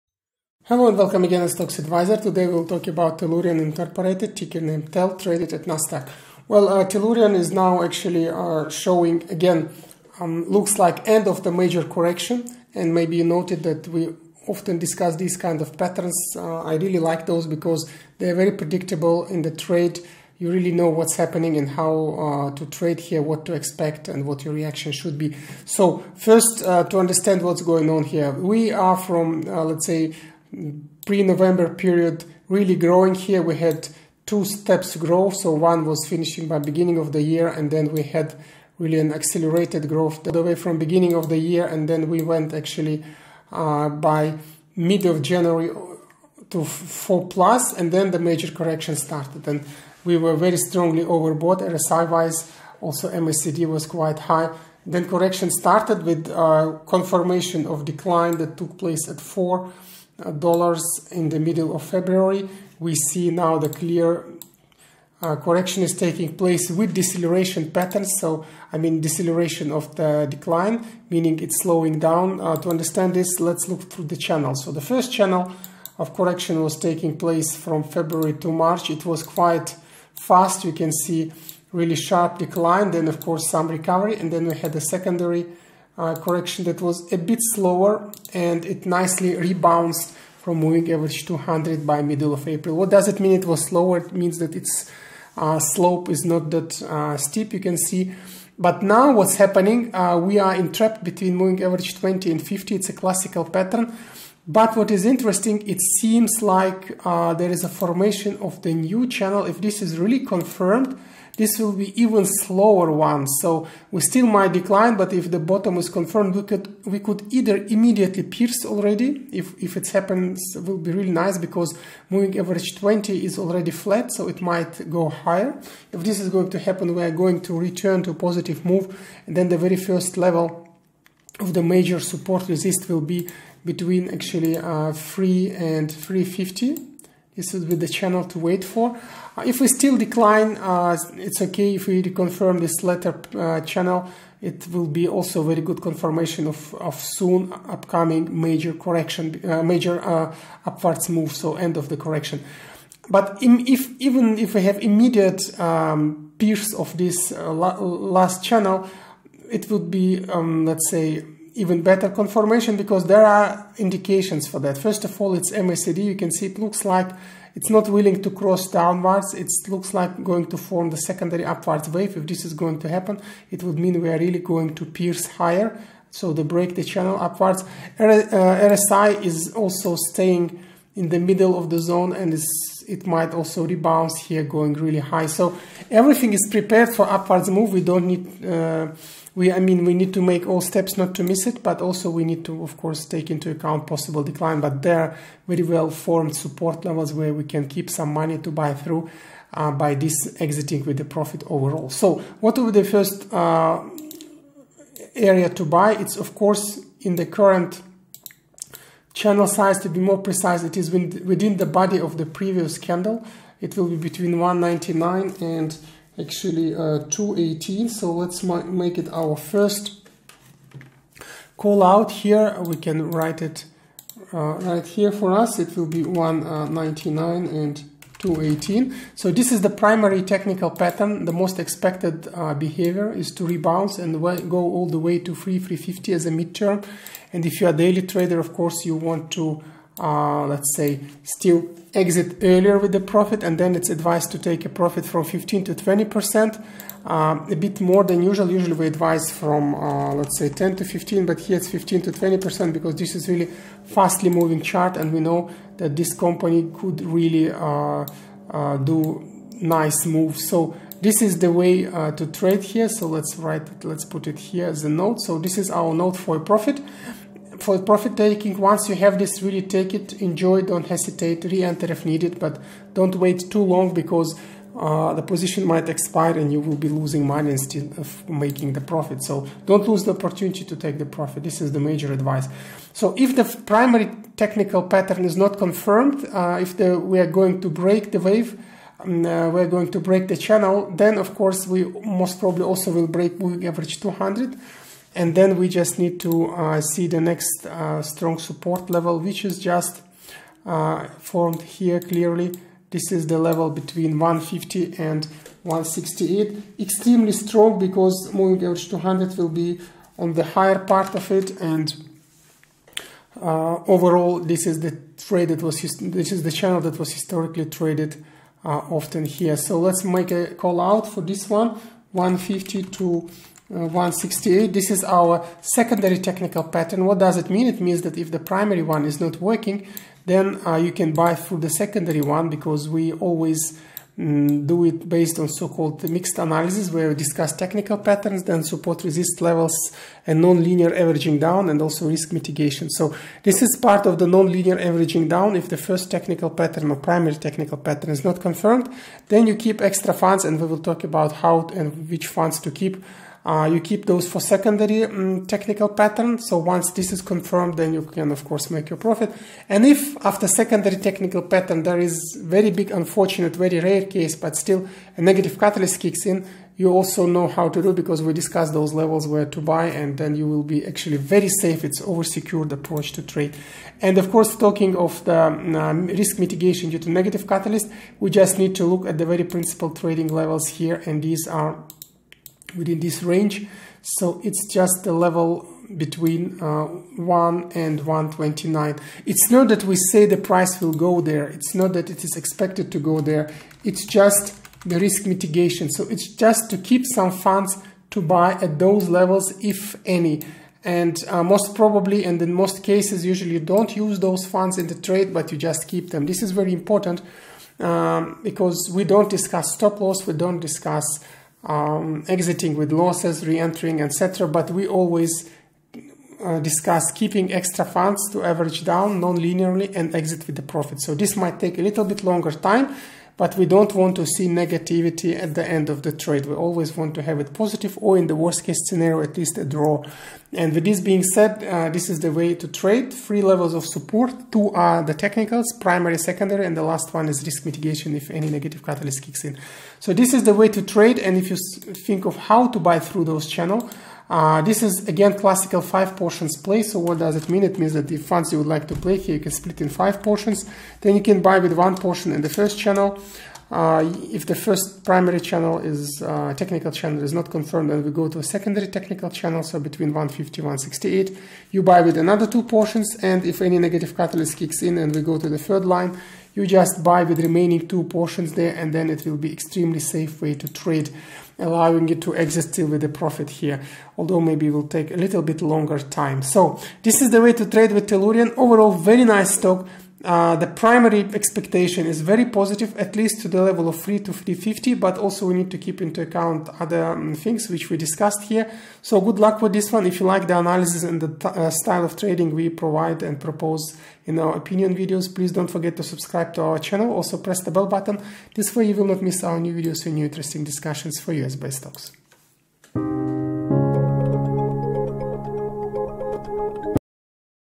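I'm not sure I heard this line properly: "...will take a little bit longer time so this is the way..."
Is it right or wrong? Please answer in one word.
right.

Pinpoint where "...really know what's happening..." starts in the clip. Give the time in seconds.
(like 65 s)
20 s.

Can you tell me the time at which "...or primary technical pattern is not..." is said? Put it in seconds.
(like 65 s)
346 s.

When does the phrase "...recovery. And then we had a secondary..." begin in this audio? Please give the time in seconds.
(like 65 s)
83 s.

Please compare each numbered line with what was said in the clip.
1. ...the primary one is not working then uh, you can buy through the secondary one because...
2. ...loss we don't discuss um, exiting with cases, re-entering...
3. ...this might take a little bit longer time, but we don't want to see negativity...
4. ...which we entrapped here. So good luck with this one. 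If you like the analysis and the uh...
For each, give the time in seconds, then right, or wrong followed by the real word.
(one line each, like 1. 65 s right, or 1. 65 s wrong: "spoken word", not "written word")
1. 328 s right
2. 409 s wrong: "losses", not "cases"
3. 421 s right
4. 487 s wrong: "discussed", not "entrapped".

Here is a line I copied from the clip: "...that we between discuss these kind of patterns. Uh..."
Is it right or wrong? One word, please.
wrong.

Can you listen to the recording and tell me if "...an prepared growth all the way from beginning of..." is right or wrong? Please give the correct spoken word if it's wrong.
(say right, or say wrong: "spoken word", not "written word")
wrong: "accelerated", not "prepared".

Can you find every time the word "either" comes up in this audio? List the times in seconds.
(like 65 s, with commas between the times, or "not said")
117 s.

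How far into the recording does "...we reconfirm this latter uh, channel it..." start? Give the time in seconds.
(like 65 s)
141 s.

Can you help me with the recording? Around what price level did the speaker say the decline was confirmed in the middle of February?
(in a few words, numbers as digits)
$4.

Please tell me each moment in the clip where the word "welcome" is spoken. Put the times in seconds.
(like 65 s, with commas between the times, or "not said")
0 s.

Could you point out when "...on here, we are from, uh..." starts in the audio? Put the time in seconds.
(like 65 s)
27 s.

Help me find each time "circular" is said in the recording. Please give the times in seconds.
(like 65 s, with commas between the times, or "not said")
not said.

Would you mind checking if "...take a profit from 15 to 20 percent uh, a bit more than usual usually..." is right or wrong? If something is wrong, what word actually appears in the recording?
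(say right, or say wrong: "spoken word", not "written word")
right.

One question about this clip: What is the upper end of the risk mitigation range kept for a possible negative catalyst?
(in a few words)
1.29.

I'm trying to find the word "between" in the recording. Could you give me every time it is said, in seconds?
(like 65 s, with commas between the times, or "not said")
101 s, 133 s, 213 s, 303 s, 385 s, 459 s.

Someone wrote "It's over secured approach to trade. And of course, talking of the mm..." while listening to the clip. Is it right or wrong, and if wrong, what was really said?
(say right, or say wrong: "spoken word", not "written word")
right.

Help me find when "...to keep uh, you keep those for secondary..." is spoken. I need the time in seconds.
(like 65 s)
352 s.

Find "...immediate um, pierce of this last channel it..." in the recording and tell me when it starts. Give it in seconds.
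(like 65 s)
154 s.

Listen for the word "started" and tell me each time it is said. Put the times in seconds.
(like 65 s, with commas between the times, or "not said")
48 s, 55 s.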